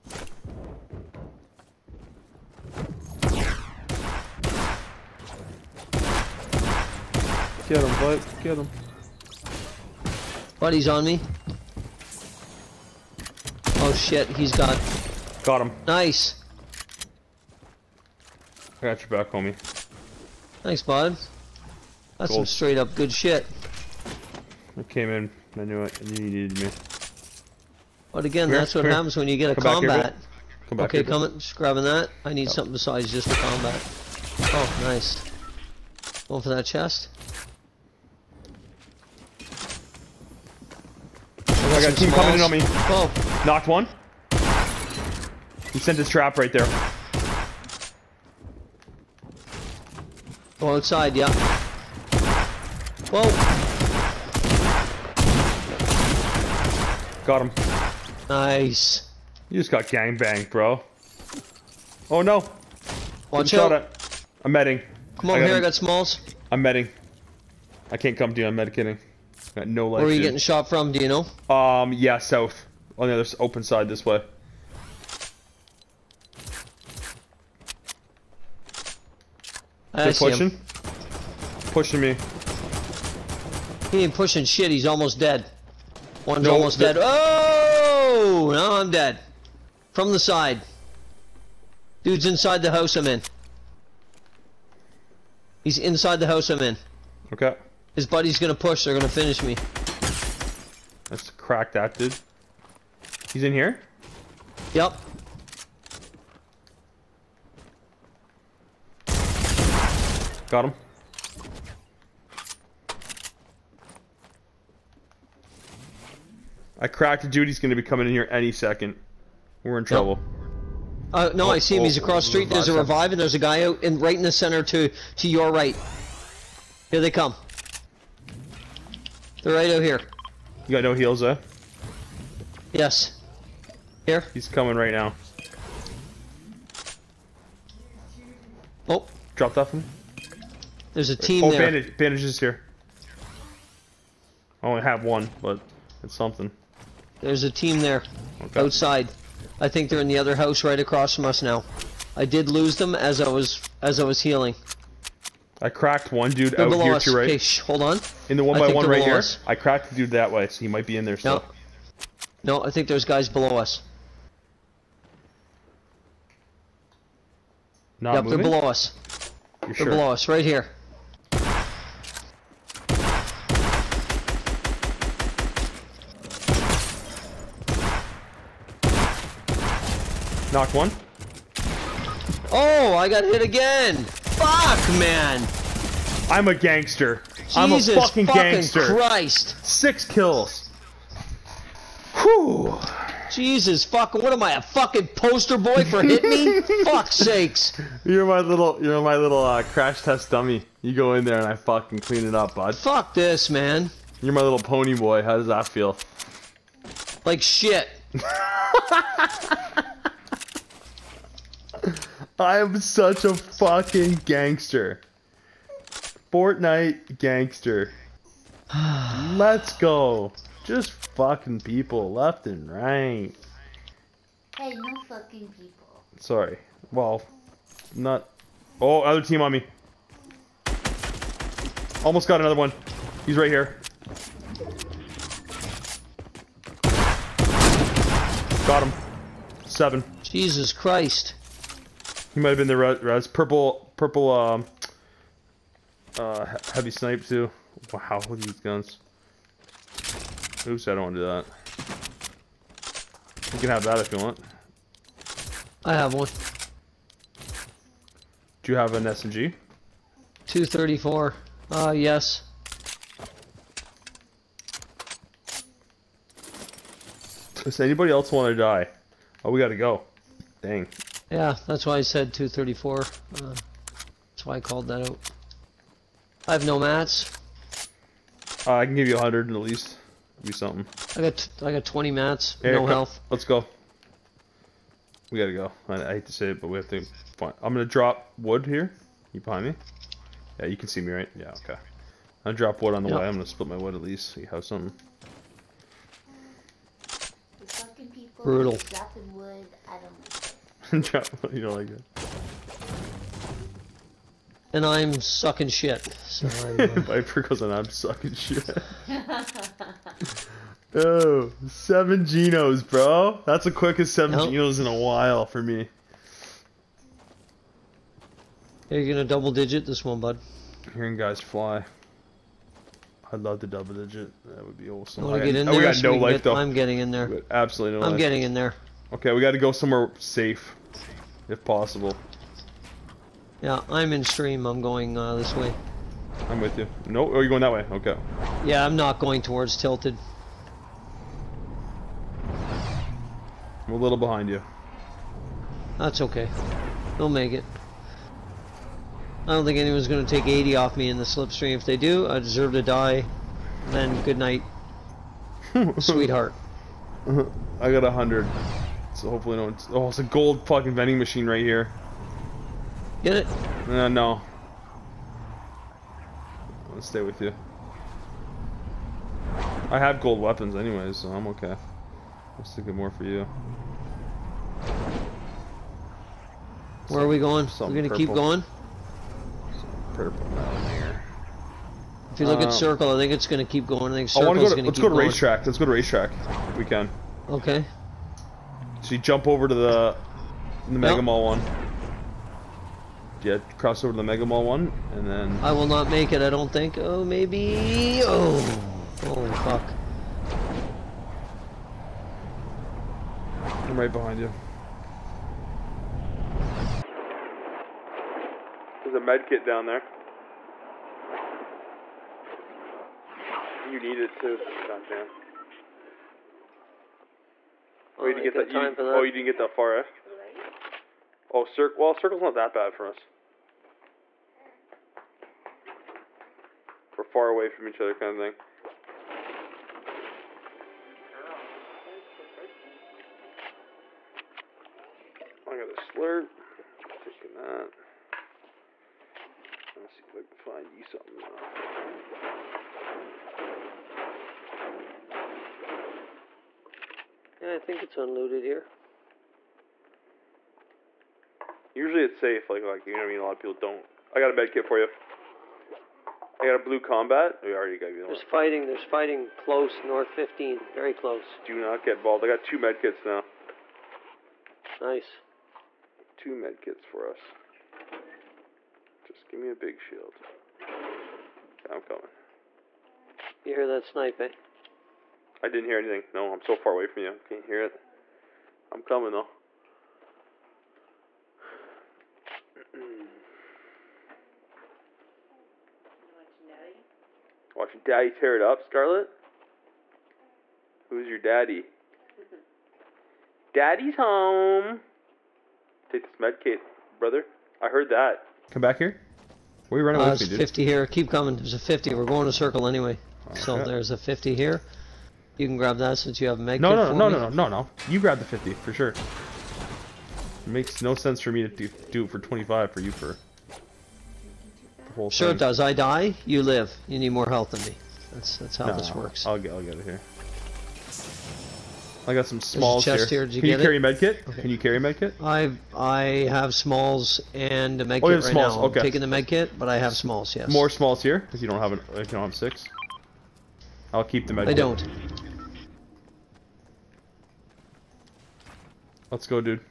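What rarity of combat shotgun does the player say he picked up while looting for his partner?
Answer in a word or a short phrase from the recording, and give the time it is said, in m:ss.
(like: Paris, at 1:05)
Blue, at 7:36.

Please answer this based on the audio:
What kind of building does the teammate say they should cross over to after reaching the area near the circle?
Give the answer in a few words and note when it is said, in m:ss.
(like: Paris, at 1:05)
Mega Mall, at 6:34.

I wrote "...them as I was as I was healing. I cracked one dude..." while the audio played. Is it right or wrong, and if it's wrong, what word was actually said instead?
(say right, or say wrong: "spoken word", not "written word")
right.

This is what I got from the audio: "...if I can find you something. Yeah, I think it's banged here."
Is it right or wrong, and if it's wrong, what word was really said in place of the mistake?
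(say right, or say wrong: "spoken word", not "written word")
wrong: "unloaded", not "banged".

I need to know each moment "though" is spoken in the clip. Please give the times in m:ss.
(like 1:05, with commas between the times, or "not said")
5:26, 7:59.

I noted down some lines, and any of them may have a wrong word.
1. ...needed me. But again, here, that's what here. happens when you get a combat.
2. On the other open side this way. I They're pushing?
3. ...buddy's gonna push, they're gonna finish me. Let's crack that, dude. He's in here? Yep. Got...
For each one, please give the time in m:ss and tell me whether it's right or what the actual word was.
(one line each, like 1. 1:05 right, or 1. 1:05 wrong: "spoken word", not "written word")
1. 0:26 right
2. 1:12 right
3. 1:38 right.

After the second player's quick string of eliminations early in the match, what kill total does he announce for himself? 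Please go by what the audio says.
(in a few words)
6.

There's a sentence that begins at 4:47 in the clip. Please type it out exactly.
Find, I'm gonna drop wood here.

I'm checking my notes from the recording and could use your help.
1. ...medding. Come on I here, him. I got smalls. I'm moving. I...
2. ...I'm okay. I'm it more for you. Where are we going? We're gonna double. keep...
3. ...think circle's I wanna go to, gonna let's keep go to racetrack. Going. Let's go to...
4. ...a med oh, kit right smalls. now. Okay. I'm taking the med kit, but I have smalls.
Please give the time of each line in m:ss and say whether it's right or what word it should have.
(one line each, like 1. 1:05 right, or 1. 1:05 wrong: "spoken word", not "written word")
1. 1:04 wrong: "medding", not "moving"
2. 6:11 wrong: "purple", not "double"
3. 6:24 right
4. 8:48 right.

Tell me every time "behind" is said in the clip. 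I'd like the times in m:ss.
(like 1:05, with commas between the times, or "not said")
4:49, 5:44, 6:44.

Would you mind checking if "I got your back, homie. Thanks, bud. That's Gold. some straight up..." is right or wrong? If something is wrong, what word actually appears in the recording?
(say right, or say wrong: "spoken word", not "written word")
right.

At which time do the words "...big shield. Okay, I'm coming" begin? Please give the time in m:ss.
7:49.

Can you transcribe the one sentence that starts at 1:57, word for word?
He's going to be coming in here any second.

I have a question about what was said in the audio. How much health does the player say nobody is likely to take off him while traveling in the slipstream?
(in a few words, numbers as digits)
80.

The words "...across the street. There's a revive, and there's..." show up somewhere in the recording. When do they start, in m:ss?
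2:02.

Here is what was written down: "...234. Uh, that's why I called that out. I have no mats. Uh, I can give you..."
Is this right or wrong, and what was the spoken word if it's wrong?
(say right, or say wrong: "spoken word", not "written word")
right.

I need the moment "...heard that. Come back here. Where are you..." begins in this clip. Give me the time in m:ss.
8:17.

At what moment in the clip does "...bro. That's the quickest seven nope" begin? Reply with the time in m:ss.
5:12.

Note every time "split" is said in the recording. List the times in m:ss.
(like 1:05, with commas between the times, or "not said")
4:53.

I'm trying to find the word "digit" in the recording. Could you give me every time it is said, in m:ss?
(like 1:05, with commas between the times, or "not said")
5:19, 5:23.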